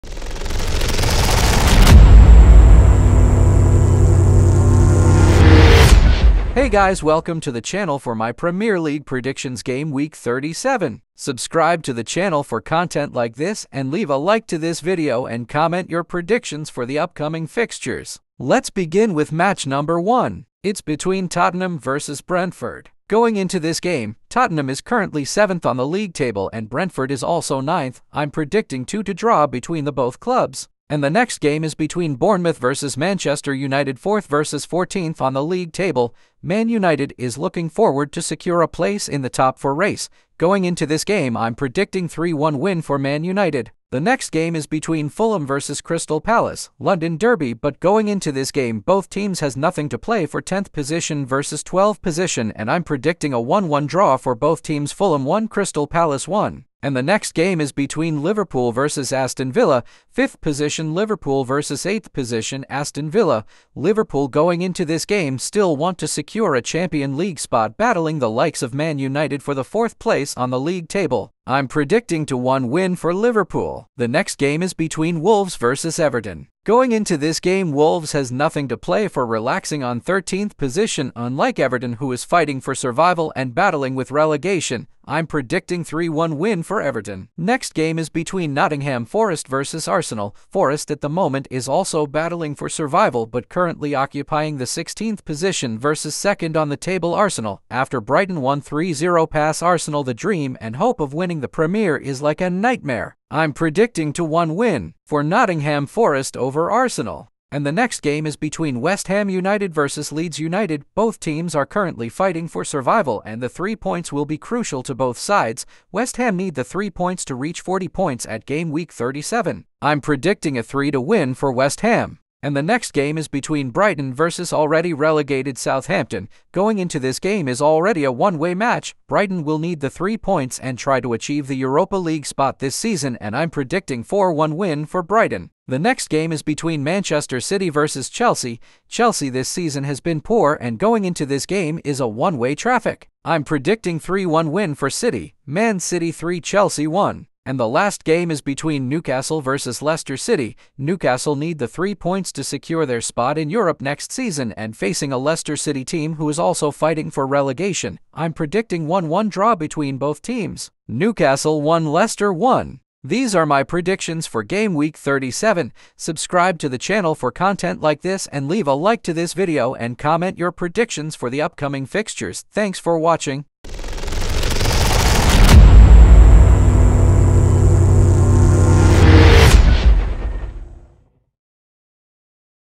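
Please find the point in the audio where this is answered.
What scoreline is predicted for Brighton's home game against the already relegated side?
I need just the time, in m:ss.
2:14.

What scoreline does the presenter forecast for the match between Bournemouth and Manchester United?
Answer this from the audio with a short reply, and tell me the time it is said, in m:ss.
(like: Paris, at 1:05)
3-1 to Manchester United, at 0:42.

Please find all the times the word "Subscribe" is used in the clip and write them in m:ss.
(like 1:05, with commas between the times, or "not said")
0:11, 2:45.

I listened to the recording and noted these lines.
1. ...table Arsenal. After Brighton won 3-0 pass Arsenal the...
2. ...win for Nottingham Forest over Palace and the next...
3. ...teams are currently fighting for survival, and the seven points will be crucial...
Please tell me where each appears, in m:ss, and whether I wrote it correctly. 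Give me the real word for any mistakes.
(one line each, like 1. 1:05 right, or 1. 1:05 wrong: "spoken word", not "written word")
1. 1:36 right
2. 1:44 wrong: "Arsenal", not "Palace"
3. 1:51 wrong: "three", not "seven".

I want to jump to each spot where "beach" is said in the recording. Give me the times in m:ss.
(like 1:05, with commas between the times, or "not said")
not said.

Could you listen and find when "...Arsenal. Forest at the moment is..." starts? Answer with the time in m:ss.
1:29.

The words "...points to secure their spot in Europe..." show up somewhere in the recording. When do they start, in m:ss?
2:31.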